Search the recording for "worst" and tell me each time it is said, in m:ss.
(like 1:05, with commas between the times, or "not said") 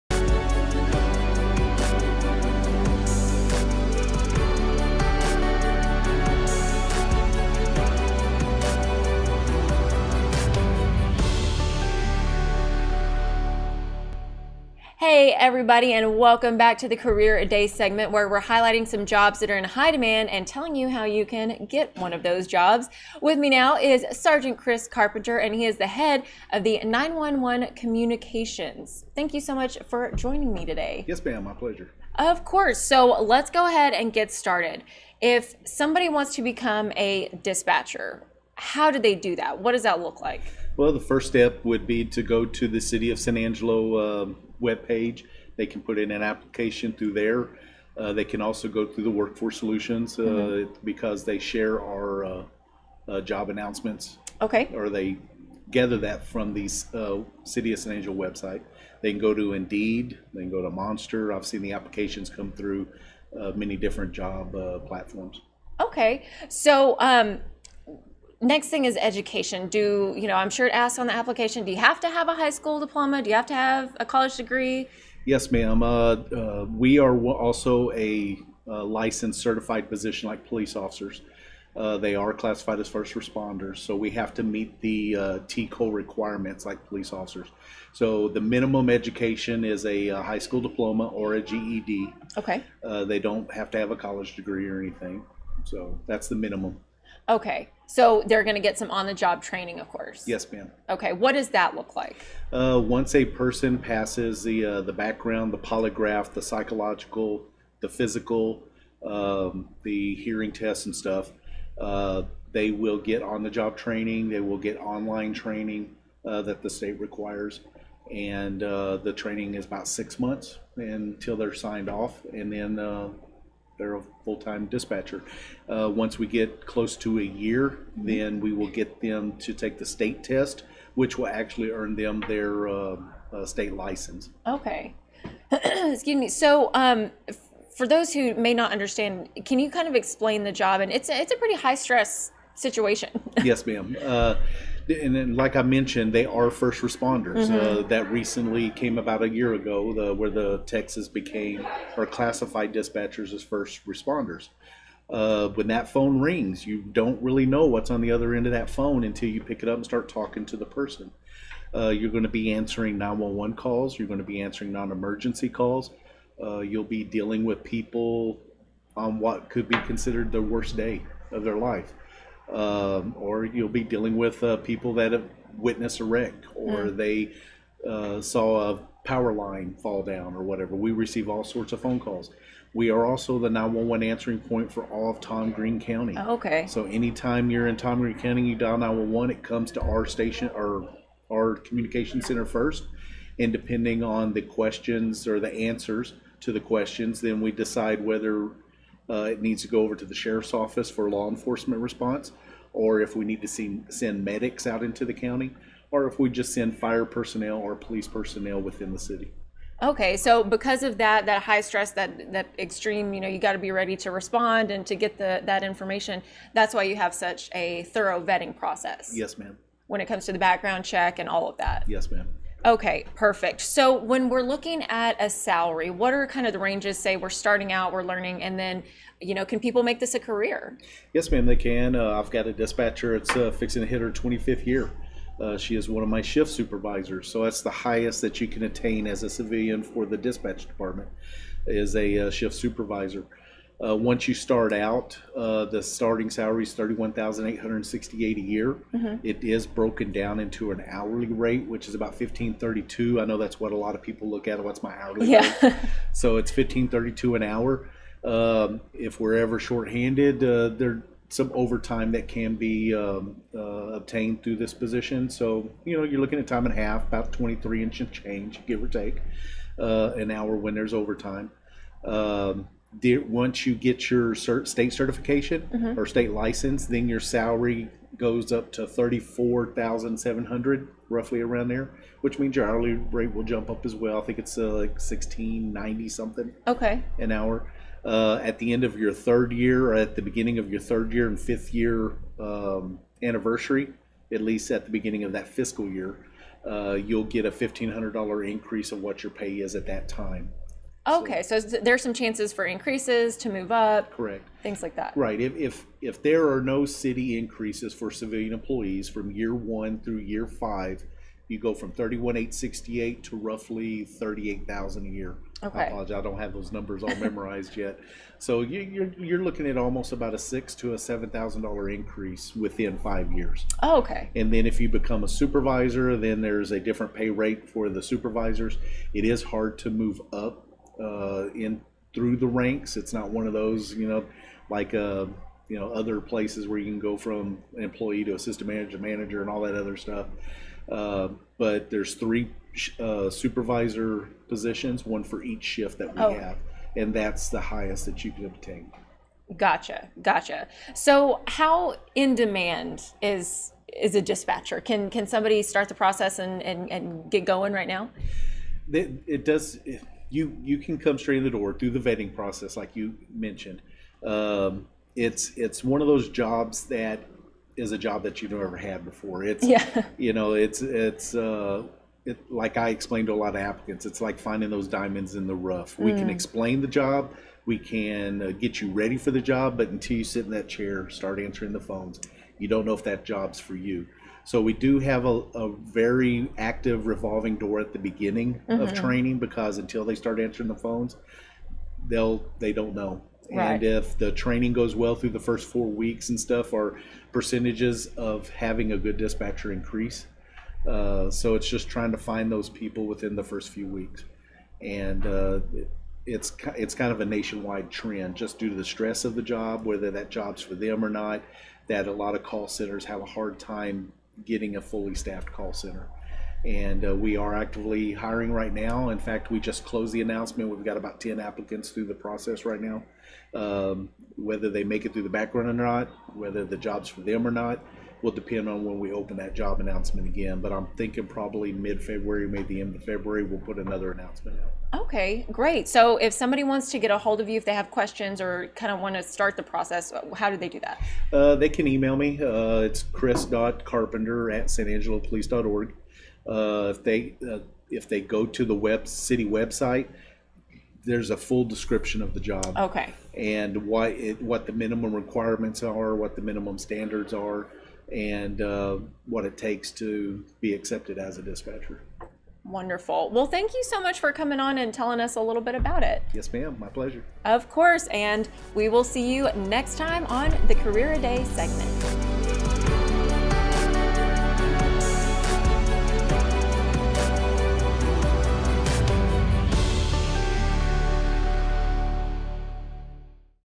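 2:50.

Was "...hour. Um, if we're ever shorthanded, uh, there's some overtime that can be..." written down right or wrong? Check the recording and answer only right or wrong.
right.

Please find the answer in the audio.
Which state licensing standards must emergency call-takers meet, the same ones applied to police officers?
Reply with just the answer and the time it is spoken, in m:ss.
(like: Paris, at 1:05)
TCOLE, at 1:25.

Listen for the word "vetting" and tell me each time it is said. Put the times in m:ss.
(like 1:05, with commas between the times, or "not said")
3:38, 6:01.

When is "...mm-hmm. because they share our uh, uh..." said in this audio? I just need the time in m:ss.
0:50.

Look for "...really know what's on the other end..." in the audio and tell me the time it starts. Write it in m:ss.
2:37.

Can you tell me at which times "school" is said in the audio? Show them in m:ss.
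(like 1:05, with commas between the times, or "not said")
1:12, 1:30.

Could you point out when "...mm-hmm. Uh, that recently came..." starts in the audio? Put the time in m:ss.
2:27.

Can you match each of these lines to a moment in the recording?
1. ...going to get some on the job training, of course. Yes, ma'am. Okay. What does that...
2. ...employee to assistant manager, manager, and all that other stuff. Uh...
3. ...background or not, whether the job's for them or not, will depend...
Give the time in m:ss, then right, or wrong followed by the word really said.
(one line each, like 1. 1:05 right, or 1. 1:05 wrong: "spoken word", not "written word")
1. 1:38 right
2. 5:37 right
3. 7:05 right.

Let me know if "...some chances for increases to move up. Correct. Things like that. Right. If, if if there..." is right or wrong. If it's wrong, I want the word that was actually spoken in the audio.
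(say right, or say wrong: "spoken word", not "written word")
right.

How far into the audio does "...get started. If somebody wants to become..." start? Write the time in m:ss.
0:34.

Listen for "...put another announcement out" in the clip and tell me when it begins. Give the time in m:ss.
7:13.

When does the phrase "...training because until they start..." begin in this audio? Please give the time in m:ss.
6:28.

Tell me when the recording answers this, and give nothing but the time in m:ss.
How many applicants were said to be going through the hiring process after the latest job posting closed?
7:00.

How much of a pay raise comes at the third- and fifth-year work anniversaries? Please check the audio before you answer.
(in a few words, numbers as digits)
$1,500.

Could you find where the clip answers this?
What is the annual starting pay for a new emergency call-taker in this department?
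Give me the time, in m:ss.
4:06.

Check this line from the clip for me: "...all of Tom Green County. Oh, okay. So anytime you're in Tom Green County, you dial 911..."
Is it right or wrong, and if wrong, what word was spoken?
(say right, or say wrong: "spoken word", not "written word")
right.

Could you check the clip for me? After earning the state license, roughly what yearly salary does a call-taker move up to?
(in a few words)
$34,700.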